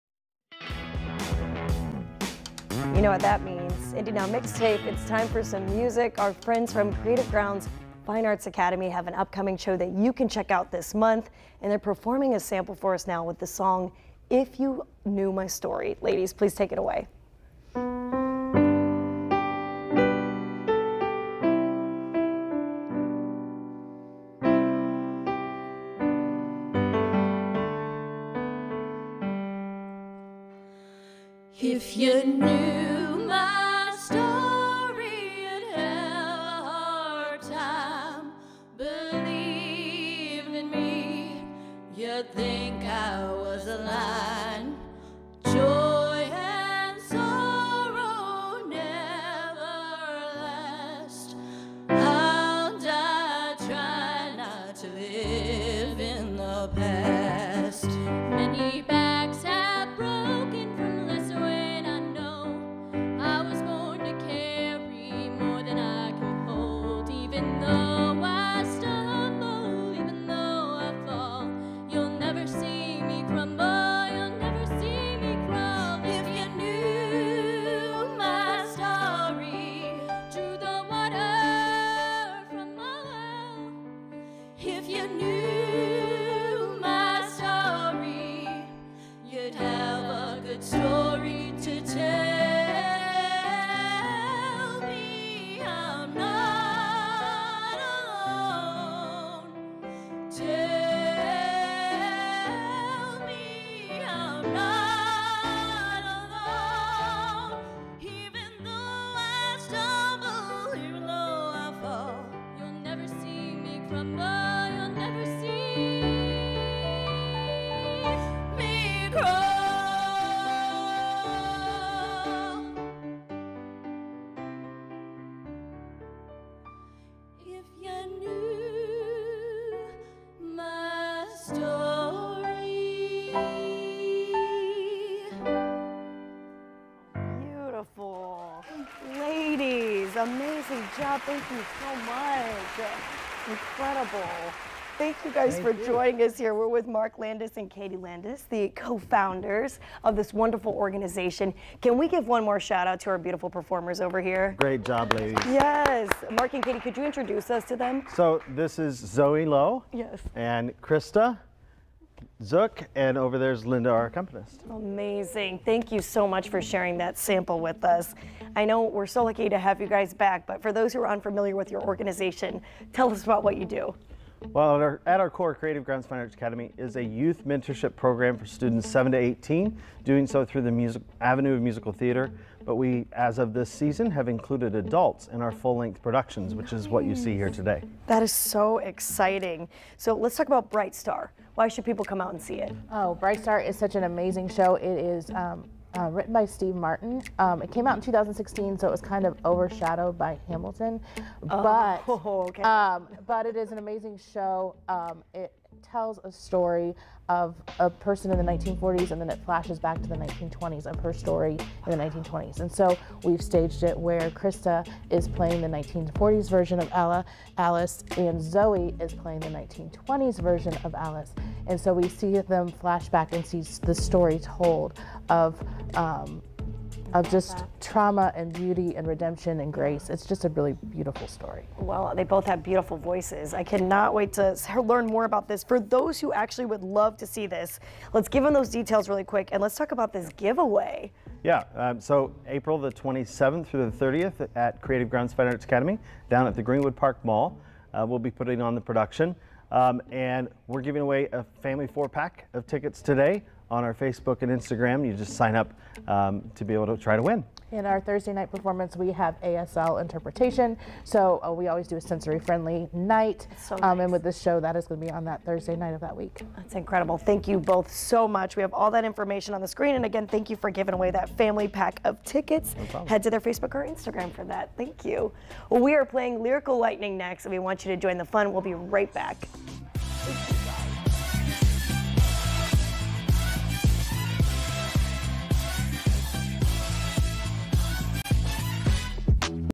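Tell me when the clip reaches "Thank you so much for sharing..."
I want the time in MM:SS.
02:45.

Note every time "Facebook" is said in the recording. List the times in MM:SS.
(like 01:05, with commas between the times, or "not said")
04:13, 04:33.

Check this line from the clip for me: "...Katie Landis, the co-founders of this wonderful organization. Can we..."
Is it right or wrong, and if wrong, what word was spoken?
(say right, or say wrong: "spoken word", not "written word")
right.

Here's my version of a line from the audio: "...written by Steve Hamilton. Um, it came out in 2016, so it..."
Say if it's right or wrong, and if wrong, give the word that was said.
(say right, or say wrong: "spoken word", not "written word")
wrong: "Martin", not "Hamilton".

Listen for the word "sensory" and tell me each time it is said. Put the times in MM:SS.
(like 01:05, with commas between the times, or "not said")
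04:22.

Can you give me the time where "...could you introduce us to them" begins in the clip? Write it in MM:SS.
02:36.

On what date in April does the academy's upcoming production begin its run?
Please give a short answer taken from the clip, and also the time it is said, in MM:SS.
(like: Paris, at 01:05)
April 27, at 04:02.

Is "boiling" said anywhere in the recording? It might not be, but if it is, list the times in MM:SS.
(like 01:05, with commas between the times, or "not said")
not said.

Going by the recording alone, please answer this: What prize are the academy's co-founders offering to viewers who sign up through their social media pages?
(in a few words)
family four pack of tickets.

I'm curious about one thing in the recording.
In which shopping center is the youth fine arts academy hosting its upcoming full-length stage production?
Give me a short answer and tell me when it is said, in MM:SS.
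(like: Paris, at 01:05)
Greenwood Park Mall, at 04:06.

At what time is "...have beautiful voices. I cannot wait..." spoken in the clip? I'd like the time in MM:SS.
03:52.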